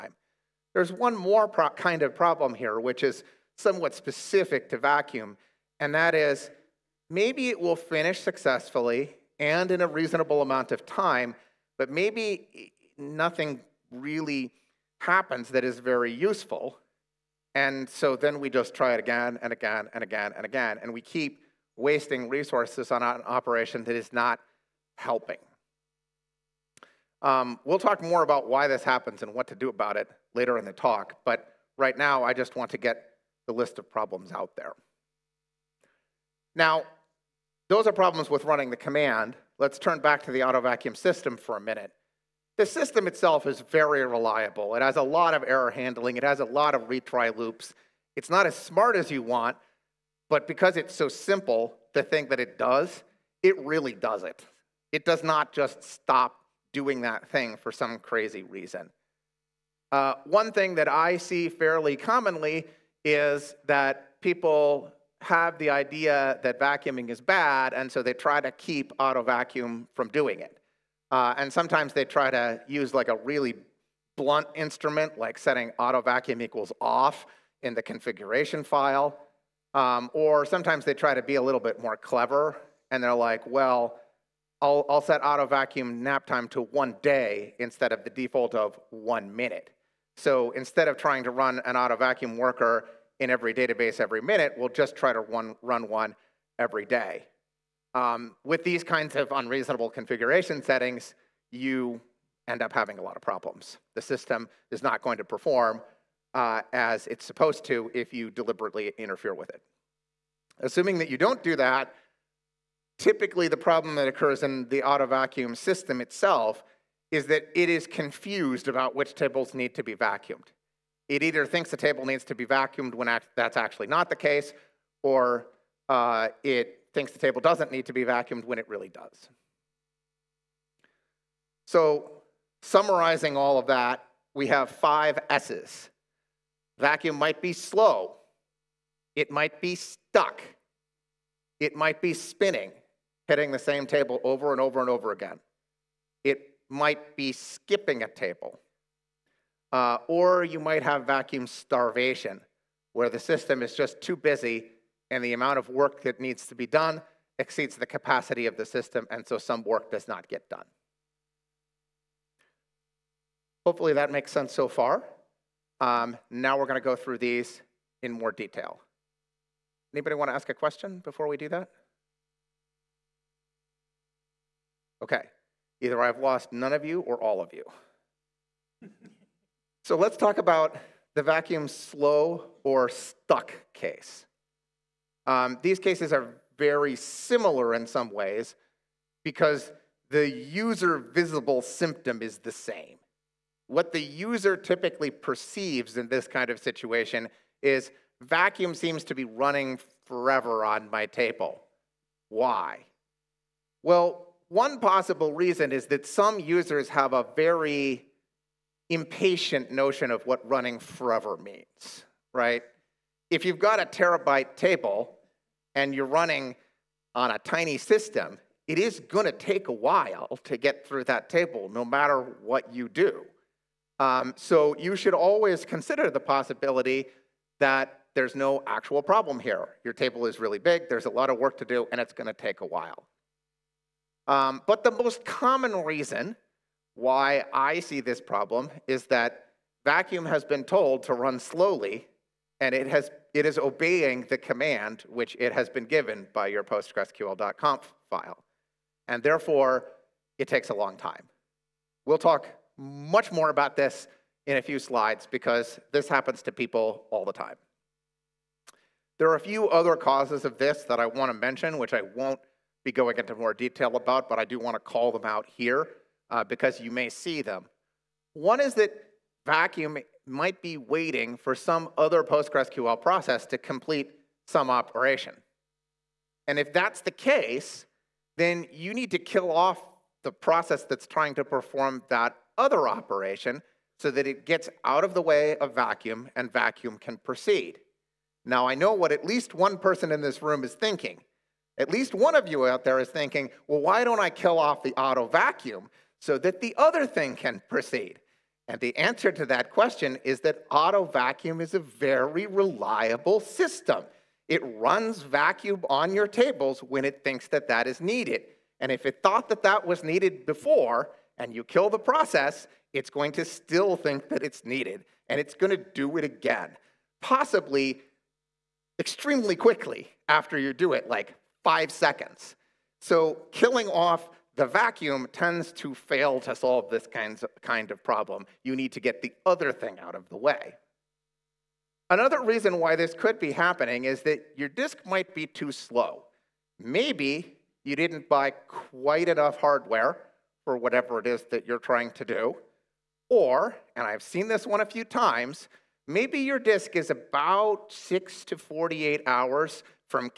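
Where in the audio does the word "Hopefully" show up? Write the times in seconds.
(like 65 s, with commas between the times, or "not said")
163 s.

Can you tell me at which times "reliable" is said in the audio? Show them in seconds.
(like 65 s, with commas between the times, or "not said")
44 s, 302 s.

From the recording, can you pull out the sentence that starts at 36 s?
Now, those are problems with running the command.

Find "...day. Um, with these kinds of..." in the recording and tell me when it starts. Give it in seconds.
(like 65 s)
96 s.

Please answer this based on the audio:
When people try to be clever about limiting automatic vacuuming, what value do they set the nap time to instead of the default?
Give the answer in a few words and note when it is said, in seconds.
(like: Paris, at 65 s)
one day, at 86 s.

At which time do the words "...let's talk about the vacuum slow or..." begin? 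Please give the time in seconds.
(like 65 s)
179 s.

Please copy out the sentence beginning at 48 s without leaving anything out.
It's not as smart as you want, but because it's so simple, the thing that it does, it really does it.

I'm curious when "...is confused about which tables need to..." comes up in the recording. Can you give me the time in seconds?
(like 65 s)
117 s.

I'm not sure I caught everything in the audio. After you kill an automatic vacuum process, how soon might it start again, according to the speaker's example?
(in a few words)
5 seconds.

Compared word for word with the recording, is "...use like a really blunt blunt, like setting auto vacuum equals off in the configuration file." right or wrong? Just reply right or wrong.
wrong.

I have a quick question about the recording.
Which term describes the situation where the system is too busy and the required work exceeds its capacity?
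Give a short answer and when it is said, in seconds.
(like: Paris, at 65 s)
vacuum starvation, at 151 s.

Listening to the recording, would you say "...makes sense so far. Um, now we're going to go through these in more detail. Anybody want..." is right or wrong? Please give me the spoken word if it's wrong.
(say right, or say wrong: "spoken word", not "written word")
right.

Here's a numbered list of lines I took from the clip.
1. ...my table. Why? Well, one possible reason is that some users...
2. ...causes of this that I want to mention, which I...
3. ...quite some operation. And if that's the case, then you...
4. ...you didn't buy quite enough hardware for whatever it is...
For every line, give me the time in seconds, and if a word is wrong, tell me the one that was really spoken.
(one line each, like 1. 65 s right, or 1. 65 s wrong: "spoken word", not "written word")
1. 200 s right
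2. 259 s right
3. 273 s wrong: "complete", not "quite"
4. 337 s right.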